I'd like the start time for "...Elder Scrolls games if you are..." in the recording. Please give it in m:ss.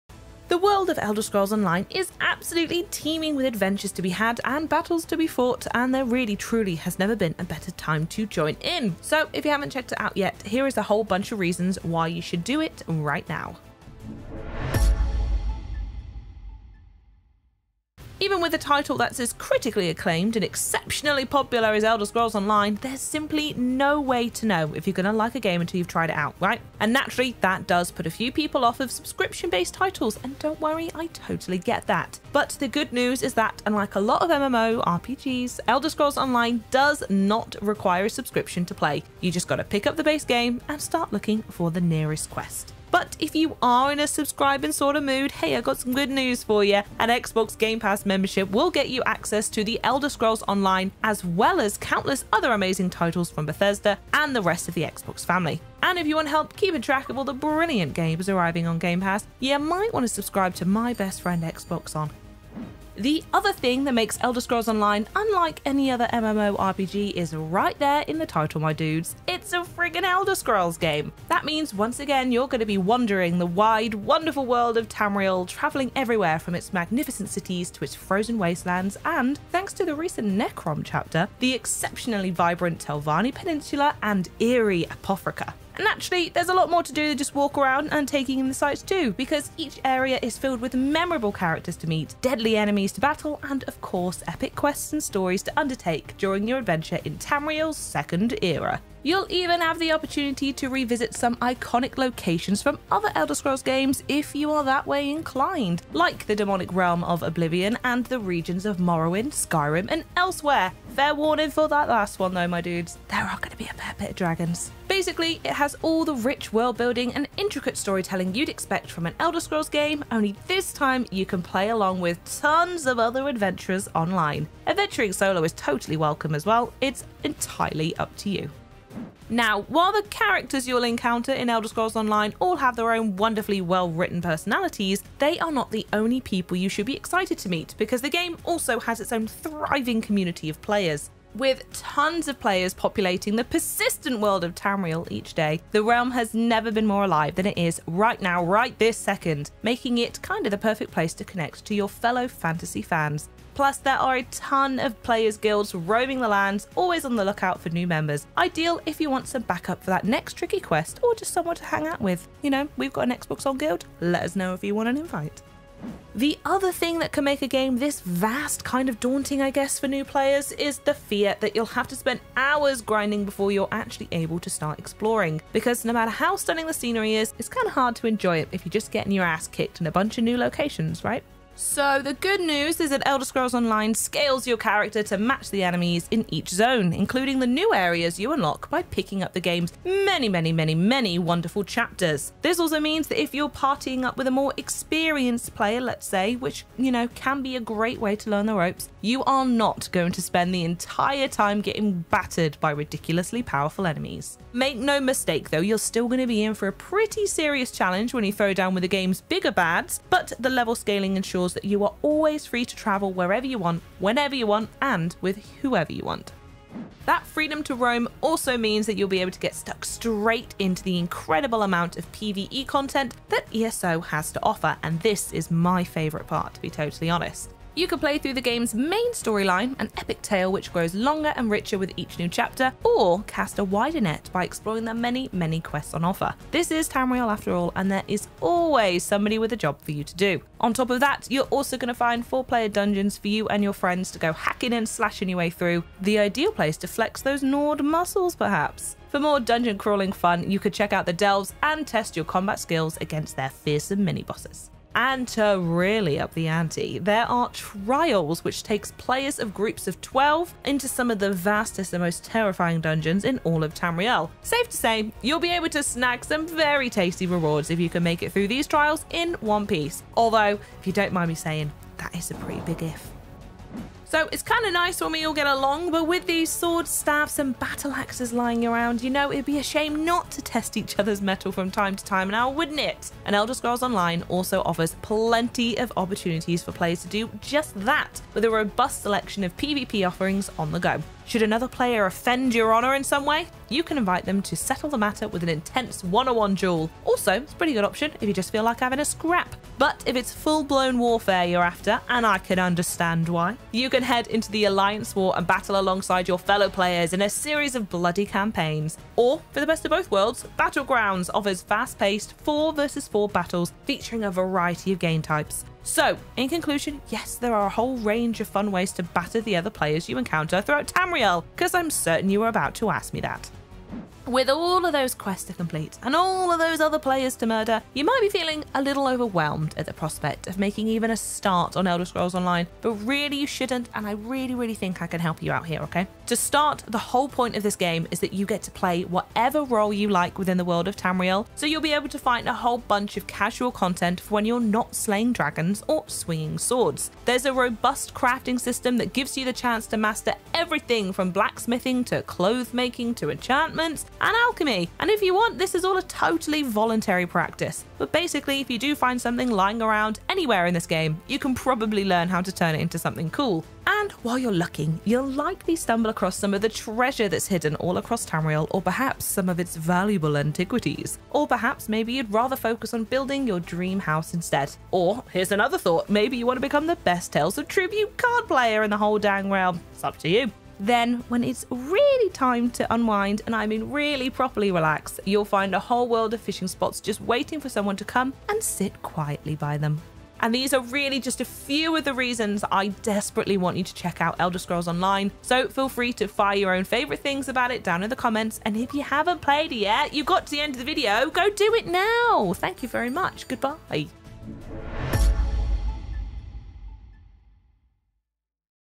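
1:43.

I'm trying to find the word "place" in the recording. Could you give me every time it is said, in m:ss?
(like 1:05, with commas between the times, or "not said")
2:30, 4:06.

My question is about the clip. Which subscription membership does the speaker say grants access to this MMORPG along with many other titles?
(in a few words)
Xbox Game Pass.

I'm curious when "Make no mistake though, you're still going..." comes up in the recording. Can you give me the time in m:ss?
3:24.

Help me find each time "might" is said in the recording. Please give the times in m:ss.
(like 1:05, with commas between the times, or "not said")
0:59, 5:28.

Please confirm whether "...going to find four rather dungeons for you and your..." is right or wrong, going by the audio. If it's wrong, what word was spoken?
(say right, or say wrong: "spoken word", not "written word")
wrong: "player", not "rather".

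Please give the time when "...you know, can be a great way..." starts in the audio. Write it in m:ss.
3:16.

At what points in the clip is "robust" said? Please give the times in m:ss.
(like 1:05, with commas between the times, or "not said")
4:48, 5:47.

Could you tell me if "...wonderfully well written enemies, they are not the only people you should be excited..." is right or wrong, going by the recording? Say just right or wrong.
wrong.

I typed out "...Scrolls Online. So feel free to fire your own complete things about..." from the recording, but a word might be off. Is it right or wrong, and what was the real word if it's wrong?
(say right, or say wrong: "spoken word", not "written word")
wrong: "favorite", not "complete".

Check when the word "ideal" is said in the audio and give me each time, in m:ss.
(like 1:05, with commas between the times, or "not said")
2:38, 4:06.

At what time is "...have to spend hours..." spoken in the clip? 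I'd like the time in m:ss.
2:51.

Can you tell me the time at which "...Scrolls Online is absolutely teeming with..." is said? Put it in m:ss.
0:01.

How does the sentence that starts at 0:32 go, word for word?
But the good news is that, unlike a lot of MMO RPGs, Elder Scrolls Online does not require a subscription to play.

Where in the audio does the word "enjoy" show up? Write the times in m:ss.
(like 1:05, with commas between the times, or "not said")
2:58.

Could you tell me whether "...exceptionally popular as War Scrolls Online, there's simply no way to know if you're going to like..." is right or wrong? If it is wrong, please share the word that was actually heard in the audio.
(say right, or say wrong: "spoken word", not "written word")
wrong: "Elder", not "War".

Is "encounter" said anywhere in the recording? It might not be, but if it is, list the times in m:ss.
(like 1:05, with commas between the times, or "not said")
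2:10, 5:20.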